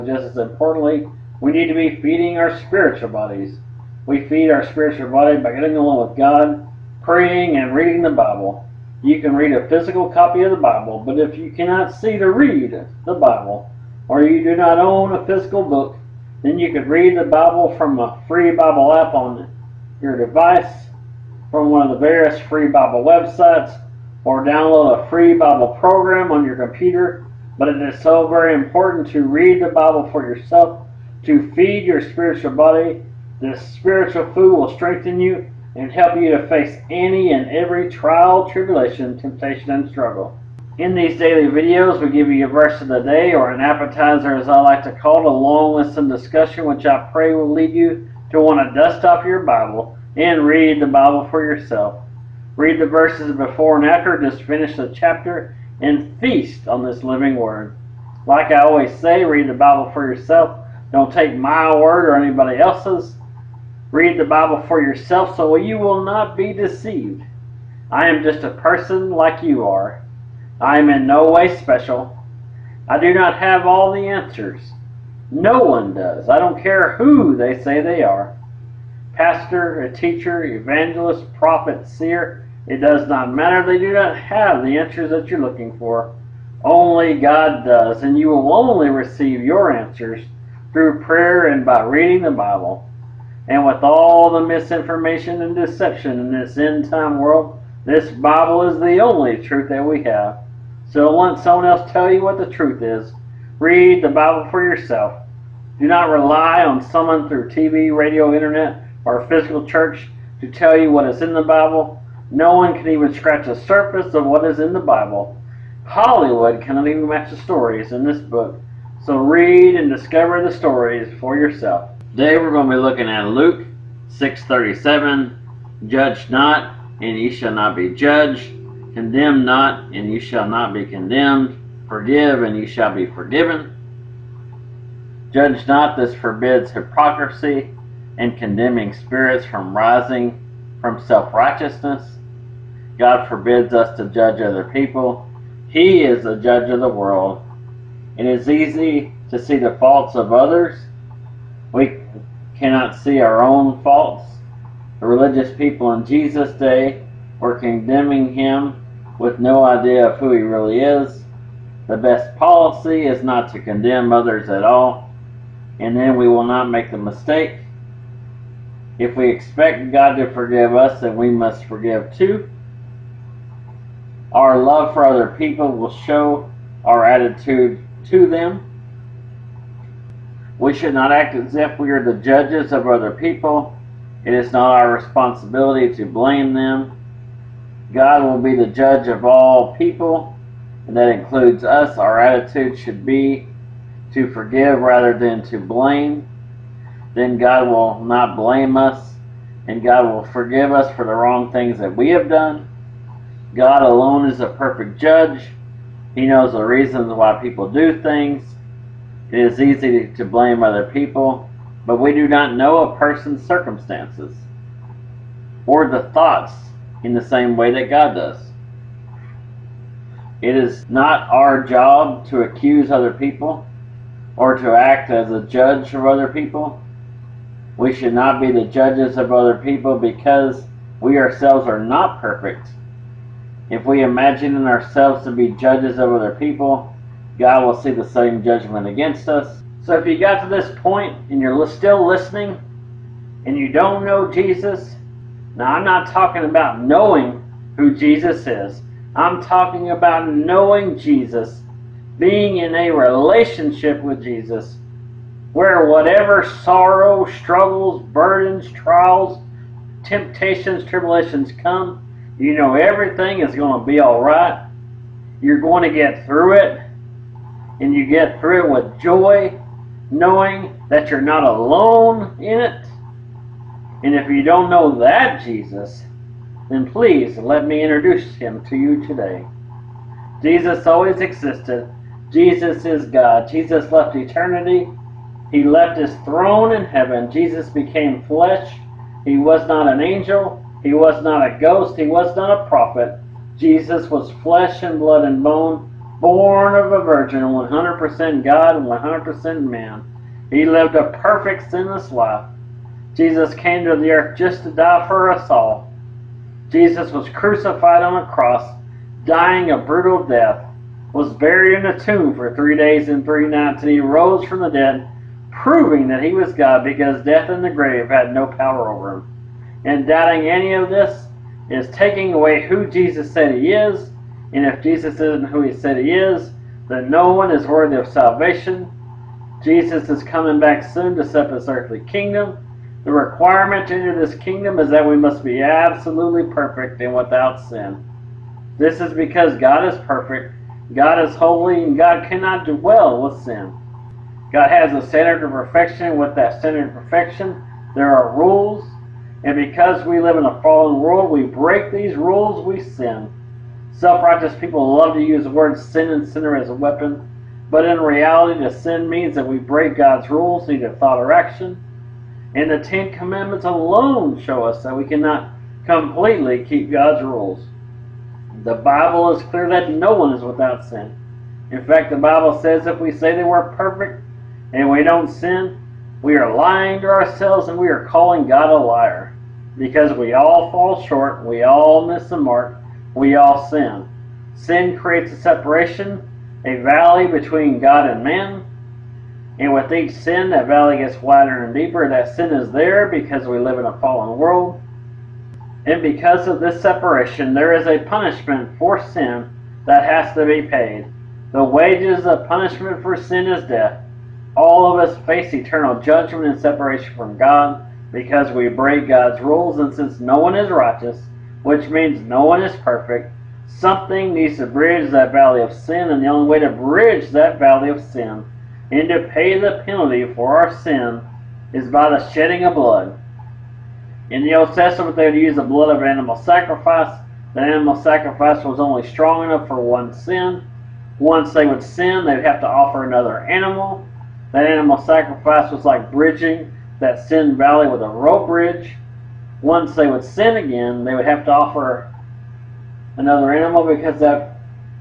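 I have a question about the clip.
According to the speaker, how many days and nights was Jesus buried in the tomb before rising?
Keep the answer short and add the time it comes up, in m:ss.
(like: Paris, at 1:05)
3, at 5:12.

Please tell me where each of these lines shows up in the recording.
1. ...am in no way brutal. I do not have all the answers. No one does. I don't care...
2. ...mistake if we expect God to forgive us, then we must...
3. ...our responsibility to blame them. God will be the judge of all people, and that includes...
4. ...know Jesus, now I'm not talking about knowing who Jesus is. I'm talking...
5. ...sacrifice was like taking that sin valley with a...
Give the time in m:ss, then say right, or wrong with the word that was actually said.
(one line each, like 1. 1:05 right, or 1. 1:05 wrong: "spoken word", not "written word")
1. 1:10 wrong: "special", not "brutal"
2. 2:46 right
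3. 3:04 right
4. 4:04 right
5. 7:14 wrong: "bridging", not "taking".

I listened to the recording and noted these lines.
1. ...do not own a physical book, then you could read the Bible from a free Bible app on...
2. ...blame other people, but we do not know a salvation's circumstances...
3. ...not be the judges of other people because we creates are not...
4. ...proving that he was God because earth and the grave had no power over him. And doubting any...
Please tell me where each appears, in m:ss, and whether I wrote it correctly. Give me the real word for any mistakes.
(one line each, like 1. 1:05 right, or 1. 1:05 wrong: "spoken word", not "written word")
1. 0:14 right
2. 3:30 wrong: "person", not "salvation"
3. 3:48 wrong: "ourselves", not "creates"
4. 5:15 wrong: "death", not "earth".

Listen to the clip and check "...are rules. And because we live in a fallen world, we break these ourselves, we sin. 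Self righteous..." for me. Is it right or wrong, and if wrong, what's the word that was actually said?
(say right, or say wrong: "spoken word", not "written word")
wrong: "rules", not "ourselves".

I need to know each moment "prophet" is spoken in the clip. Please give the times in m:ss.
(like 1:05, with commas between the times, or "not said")
1:21, 4:52.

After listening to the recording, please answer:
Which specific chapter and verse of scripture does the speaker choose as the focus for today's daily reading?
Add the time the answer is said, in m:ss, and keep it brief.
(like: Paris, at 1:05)
Luke 6:37, at 2:03.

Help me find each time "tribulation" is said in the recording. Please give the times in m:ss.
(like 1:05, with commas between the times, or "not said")
0:38, 4:20.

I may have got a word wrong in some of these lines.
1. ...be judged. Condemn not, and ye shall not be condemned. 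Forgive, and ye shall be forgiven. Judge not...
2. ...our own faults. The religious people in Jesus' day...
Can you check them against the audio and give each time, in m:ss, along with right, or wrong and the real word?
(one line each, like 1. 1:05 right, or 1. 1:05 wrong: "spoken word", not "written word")
1. 2:07 right
2. 2:33 right.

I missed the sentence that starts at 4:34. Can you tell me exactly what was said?
And if you don't know that Jesus, then please let me introduce him to you today.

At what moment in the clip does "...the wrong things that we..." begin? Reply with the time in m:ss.
3:21.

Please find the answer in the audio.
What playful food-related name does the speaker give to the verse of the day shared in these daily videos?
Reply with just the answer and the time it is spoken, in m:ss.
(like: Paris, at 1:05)
an appetizer, at 0:43.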